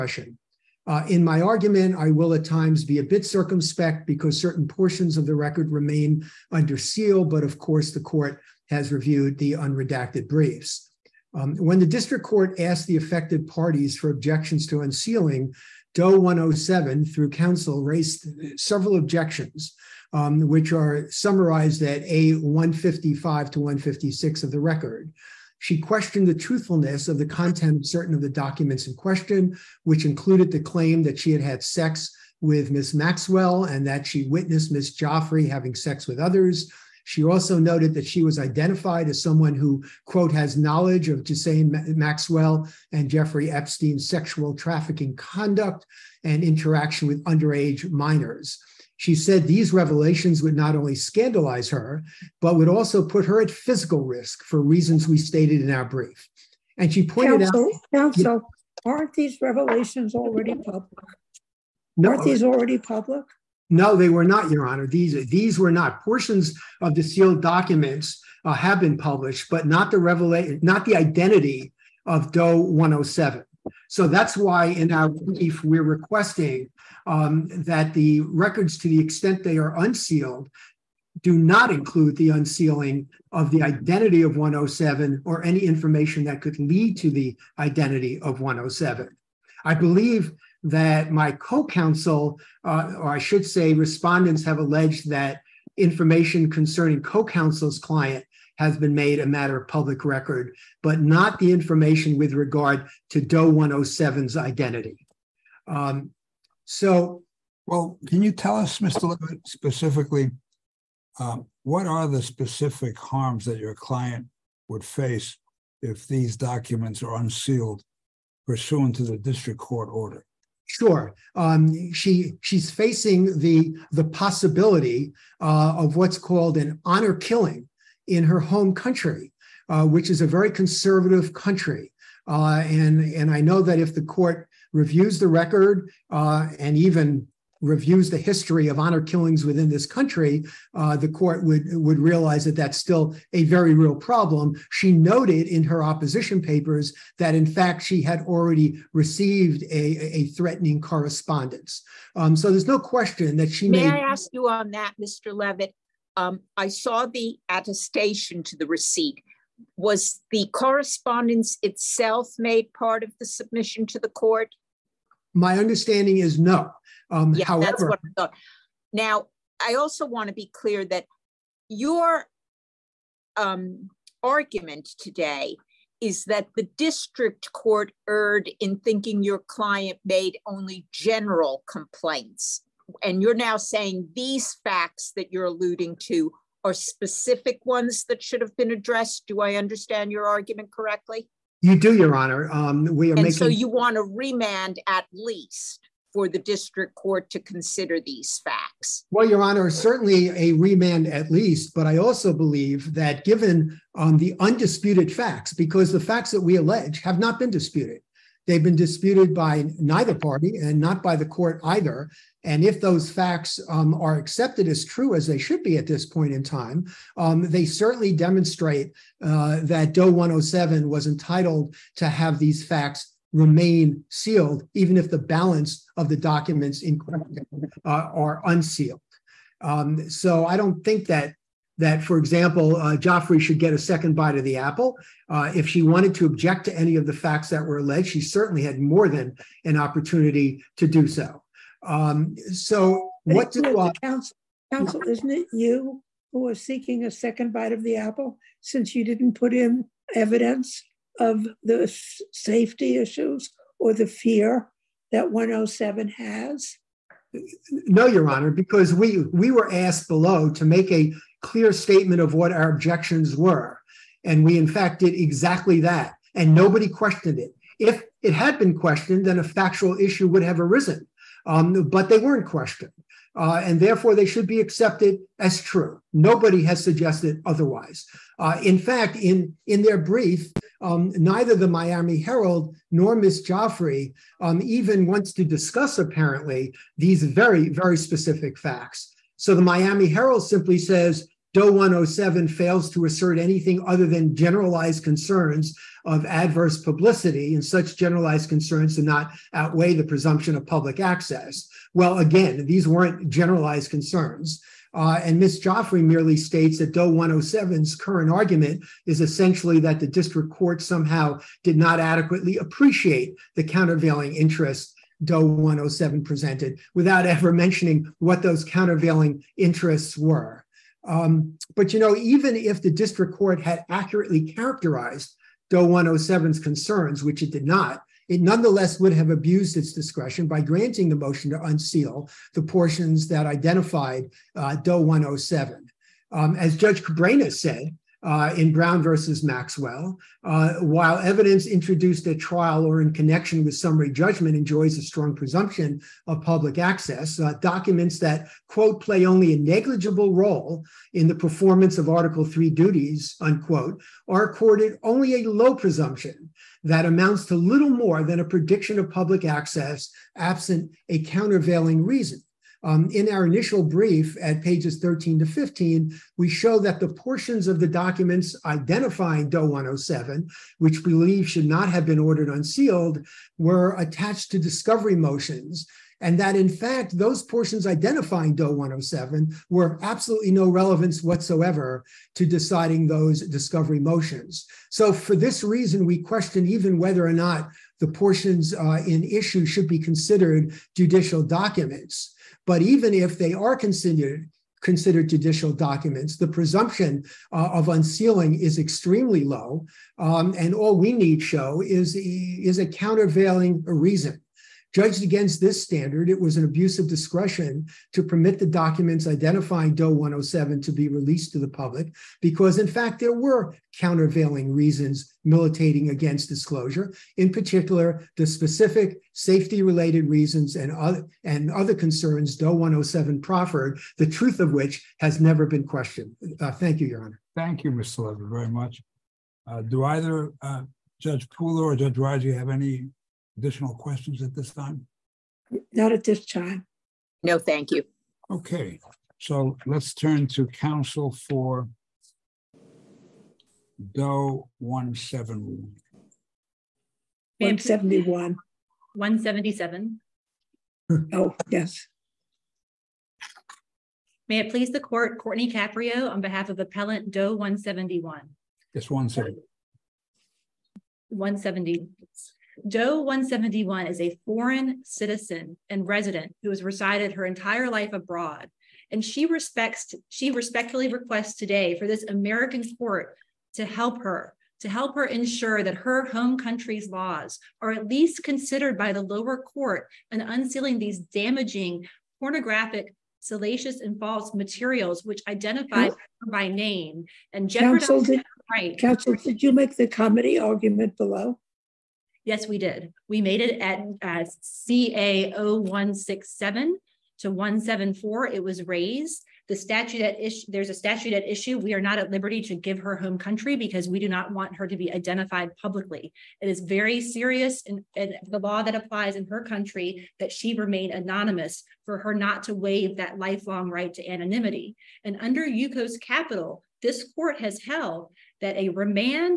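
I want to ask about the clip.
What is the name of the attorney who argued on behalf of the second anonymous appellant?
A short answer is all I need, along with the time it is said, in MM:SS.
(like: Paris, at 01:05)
Courtney Caprio, at 07:35.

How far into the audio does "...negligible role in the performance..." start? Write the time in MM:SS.
05:49.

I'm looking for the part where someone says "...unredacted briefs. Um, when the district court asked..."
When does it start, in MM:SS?
00:09.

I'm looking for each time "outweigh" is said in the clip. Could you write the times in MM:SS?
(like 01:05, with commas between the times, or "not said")
04:59.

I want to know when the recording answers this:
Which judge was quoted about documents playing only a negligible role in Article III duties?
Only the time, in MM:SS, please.
05:36.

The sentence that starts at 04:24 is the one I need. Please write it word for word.
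And we, in fact, did exactly that.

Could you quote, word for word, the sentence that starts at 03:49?
Um, so I don't think that that, for example, uh, Giuffre should get a second bite of the apple.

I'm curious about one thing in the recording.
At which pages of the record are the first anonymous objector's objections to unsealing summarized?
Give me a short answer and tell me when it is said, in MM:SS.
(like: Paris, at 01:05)
A155 to 156, at 00:22.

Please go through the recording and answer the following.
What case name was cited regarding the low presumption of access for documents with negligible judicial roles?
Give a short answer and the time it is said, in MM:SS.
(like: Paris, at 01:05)
Brown versus Maxwell, at 05:38.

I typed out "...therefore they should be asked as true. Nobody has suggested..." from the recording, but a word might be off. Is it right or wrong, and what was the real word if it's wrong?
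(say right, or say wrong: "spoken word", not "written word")
wrong: "accepted", not "asked".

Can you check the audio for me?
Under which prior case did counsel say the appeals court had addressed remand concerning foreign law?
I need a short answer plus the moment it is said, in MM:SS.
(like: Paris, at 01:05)
Yukos Capital, at 08:35.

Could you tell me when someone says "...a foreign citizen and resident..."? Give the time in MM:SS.
07:44.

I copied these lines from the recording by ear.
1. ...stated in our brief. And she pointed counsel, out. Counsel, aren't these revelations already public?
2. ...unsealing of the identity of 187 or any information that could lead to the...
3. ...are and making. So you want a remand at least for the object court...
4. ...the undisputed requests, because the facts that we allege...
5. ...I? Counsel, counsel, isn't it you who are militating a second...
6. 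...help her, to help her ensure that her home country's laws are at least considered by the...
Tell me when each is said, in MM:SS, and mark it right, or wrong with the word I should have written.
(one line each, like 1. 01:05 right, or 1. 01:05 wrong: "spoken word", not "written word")
1. 00:55 right
2. 01:22 wrong: "107", not "187"
3. 03:13 wrong: "district", not "object"
4. 03:24 wrong: "facts", not "requests"
5. 04:03 wrong: "seeking", not "militating"
6. 07:53 right.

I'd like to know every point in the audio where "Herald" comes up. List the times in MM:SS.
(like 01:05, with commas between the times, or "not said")
04:42, 04:50.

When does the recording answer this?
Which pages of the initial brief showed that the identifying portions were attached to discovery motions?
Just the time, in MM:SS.
06:04.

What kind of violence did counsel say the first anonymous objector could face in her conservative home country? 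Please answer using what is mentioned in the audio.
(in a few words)
honor killing.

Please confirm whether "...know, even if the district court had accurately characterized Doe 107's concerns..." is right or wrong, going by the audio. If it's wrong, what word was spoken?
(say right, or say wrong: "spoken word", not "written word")
right.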